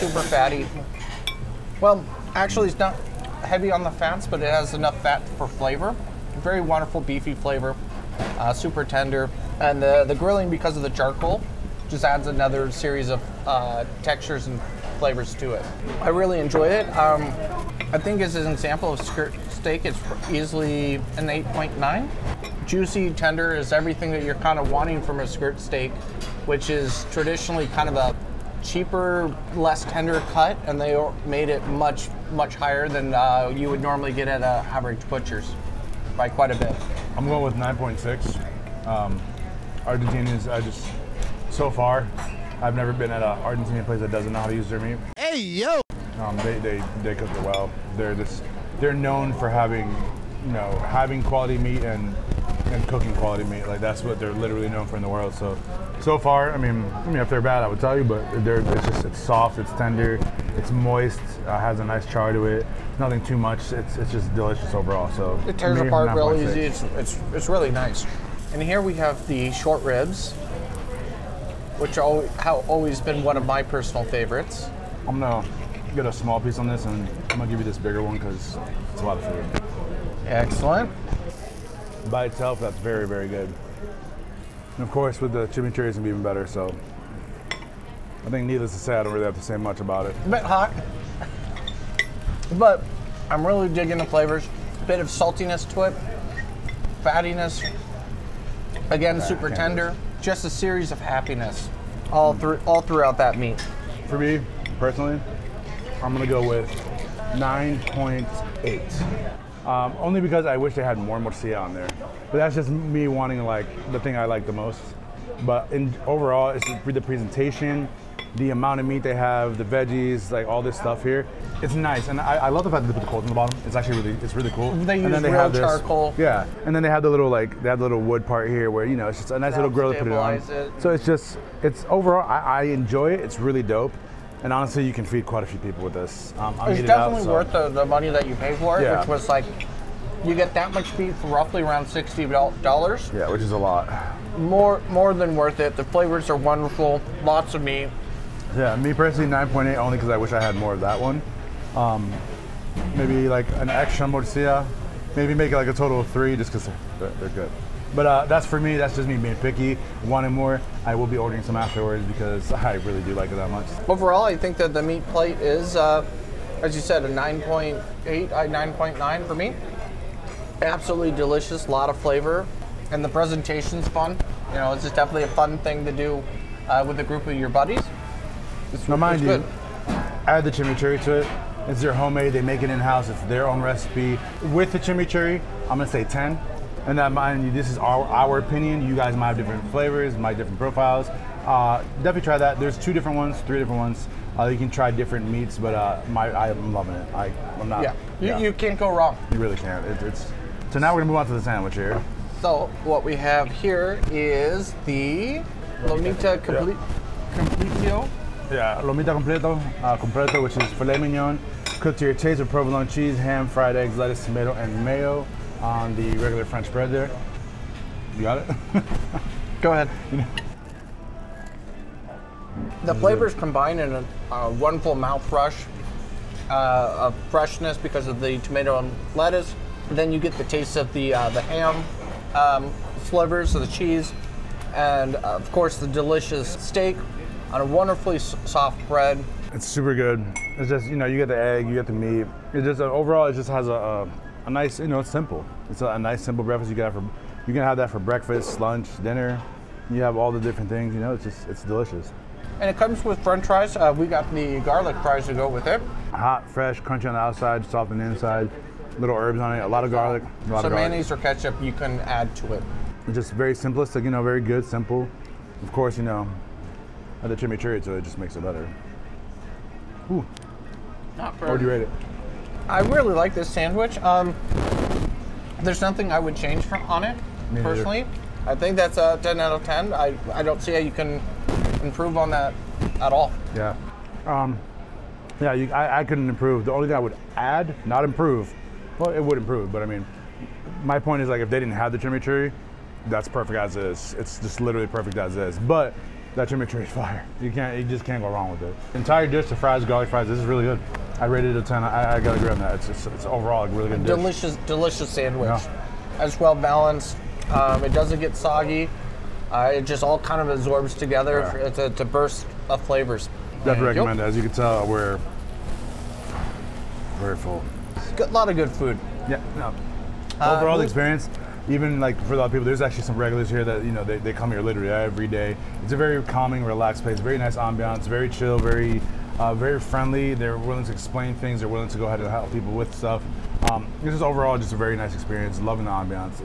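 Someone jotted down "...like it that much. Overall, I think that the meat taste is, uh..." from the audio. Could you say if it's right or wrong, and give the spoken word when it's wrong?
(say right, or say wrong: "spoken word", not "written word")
wrong: "plate", not "taste".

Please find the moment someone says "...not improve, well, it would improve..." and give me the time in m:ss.
4:47.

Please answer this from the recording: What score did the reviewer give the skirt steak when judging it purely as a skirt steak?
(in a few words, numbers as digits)
8.9.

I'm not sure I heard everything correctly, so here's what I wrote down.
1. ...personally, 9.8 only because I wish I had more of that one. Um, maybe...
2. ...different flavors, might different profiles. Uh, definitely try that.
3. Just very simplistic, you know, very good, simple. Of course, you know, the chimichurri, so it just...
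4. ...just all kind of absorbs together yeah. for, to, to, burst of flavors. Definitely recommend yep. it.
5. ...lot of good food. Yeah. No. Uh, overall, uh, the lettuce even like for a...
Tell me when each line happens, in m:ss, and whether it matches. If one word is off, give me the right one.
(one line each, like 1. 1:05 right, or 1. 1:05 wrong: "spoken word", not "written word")
1. 2:28 right
2. 3:09 right
3. 4:23 right
4. 5:09 right
5. 5:18 wrong: "experience", not "lettuce".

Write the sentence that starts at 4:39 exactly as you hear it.
I, I don't see how you can improve on that at all.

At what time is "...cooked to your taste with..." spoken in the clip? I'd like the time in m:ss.
3:31.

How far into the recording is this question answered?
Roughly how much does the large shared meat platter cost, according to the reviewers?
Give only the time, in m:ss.
2:21.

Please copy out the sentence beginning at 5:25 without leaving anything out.
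It's a very calming, relaxed place.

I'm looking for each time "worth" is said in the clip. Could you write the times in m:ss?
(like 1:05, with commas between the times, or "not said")
2:17, 2:25.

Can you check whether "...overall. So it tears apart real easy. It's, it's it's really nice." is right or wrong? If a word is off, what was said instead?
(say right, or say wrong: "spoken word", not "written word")
right.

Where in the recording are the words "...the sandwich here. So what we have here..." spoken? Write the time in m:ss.
3:21.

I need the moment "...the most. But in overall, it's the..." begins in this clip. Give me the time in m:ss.
1:54.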